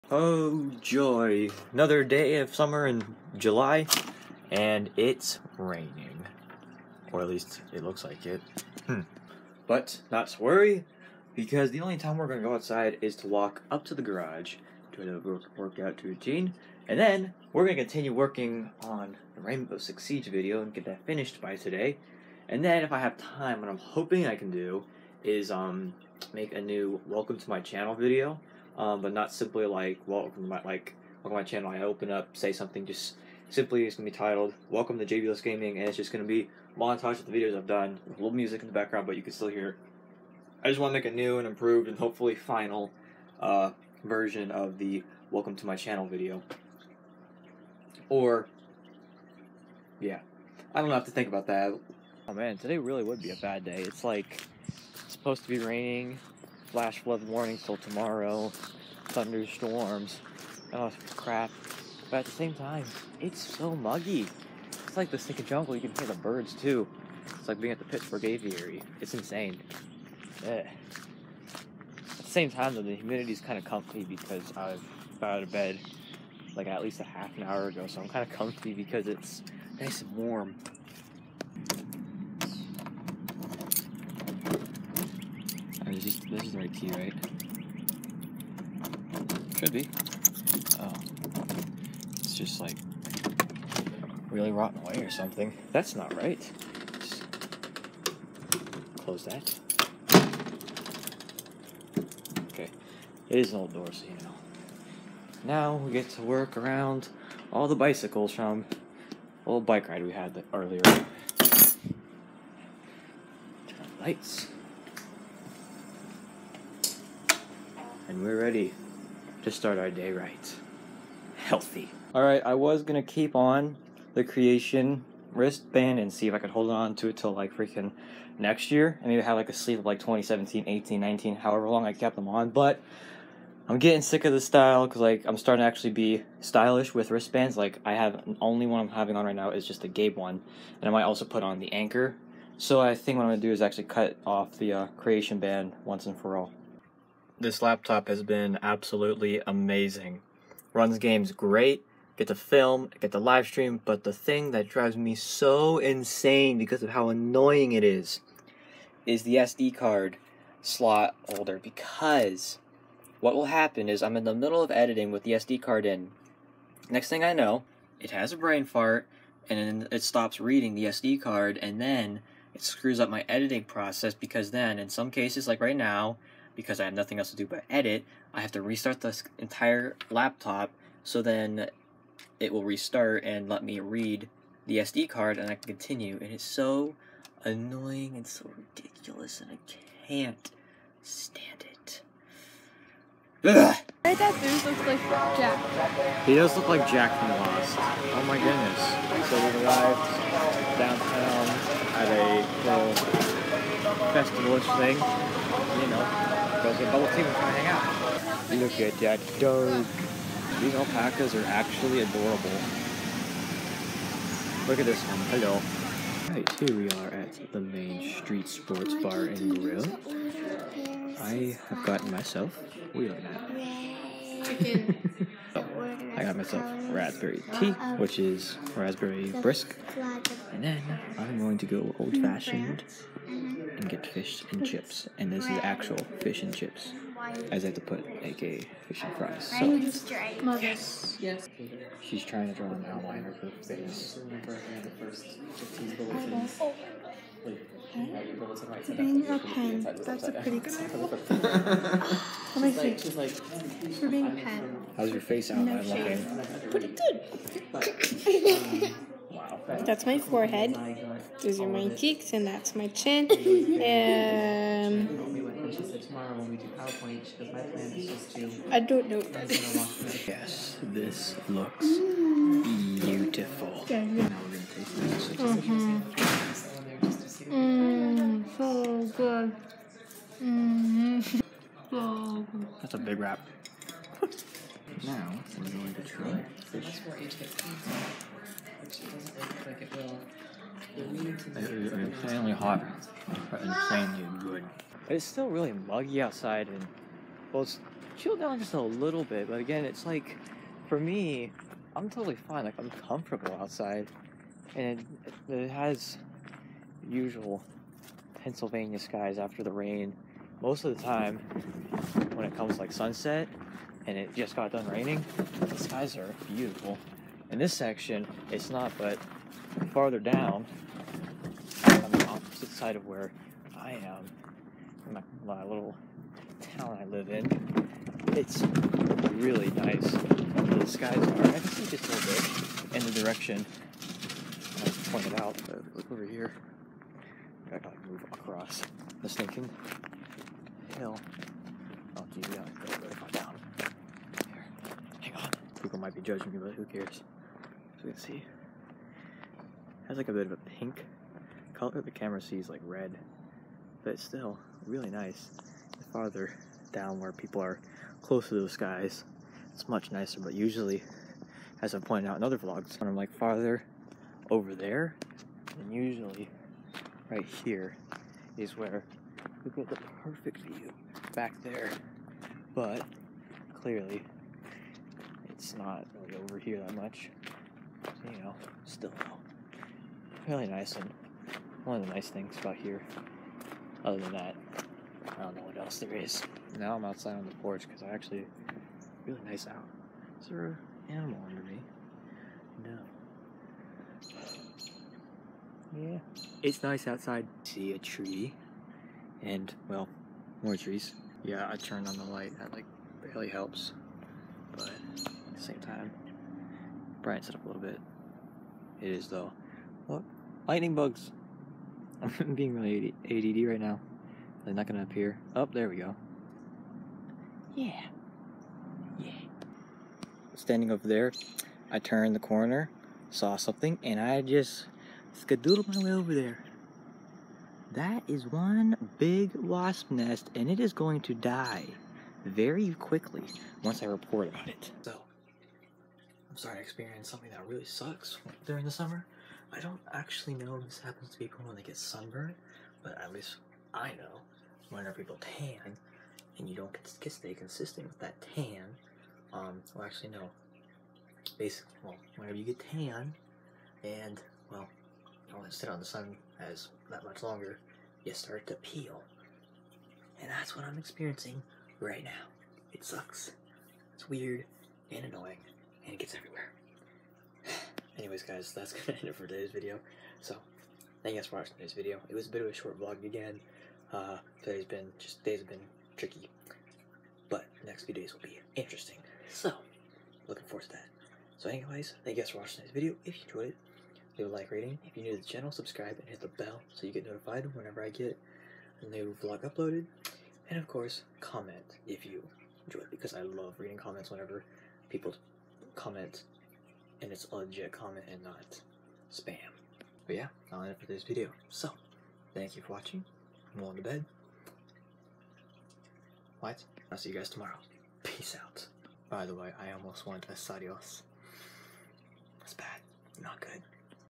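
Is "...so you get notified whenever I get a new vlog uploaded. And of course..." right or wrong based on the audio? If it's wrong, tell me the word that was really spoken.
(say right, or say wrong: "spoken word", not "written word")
right.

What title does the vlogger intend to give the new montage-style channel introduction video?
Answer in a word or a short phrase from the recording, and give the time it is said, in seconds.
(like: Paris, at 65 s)
Welcome to Jaybulus Gaming, at 34 s.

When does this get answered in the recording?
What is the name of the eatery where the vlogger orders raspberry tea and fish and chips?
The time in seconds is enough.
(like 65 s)
217 s.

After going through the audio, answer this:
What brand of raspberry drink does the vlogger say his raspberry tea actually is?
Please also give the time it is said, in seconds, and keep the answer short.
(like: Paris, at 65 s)
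Brisk, at 229 s.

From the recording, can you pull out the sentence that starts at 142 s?
So I think what I'm gonna do is actually cut off the uh, Creation band once and for all.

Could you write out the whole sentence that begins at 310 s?
Most of the time, when it comes like sunset, and it just got done raining, the skies are beautiful.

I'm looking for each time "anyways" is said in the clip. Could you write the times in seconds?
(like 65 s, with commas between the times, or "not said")
468 s, 481 s.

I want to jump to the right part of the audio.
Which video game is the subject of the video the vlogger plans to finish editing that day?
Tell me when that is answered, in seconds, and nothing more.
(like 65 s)
19 s.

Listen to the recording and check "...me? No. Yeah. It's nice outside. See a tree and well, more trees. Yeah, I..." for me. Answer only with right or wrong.
right.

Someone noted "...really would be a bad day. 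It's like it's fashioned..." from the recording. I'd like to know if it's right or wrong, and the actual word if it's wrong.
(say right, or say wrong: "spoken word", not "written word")
wrong: "supposed", not "fashioned".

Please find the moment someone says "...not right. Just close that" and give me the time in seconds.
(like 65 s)
95 s.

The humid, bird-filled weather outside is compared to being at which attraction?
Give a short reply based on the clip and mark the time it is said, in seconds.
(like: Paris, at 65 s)
Pittsburgh aviary, at 67 s.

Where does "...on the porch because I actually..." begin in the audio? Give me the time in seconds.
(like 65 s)
387 s.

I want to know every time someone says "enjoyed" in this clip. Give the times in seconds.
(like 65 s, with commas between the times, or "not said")
483 s, 492 s.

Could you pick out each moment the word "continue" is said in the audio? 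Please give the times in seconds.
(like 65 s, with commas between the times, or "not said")
17 s, 185 s.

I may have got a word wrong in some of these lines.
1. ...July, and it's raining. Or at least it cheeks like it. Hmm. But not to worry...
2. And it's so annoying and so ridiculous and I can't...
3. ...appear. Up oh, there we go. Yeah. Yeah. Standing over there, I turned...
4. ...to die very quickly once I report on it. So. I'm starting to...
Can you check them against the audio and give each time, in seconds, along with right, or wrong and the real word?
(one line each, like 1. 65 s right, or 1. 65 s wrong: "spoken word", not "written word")
1. 3 s wrong: "looks", not "cheeks"
2. 186 s right
3. 415 s right
4. 431 s right.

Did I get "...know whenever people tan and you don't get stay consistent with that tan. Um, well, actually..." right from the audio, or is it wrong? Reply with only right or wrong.
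right.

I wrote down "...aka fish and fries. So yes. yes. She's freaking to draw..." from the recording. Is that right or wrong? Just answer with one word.
wrong.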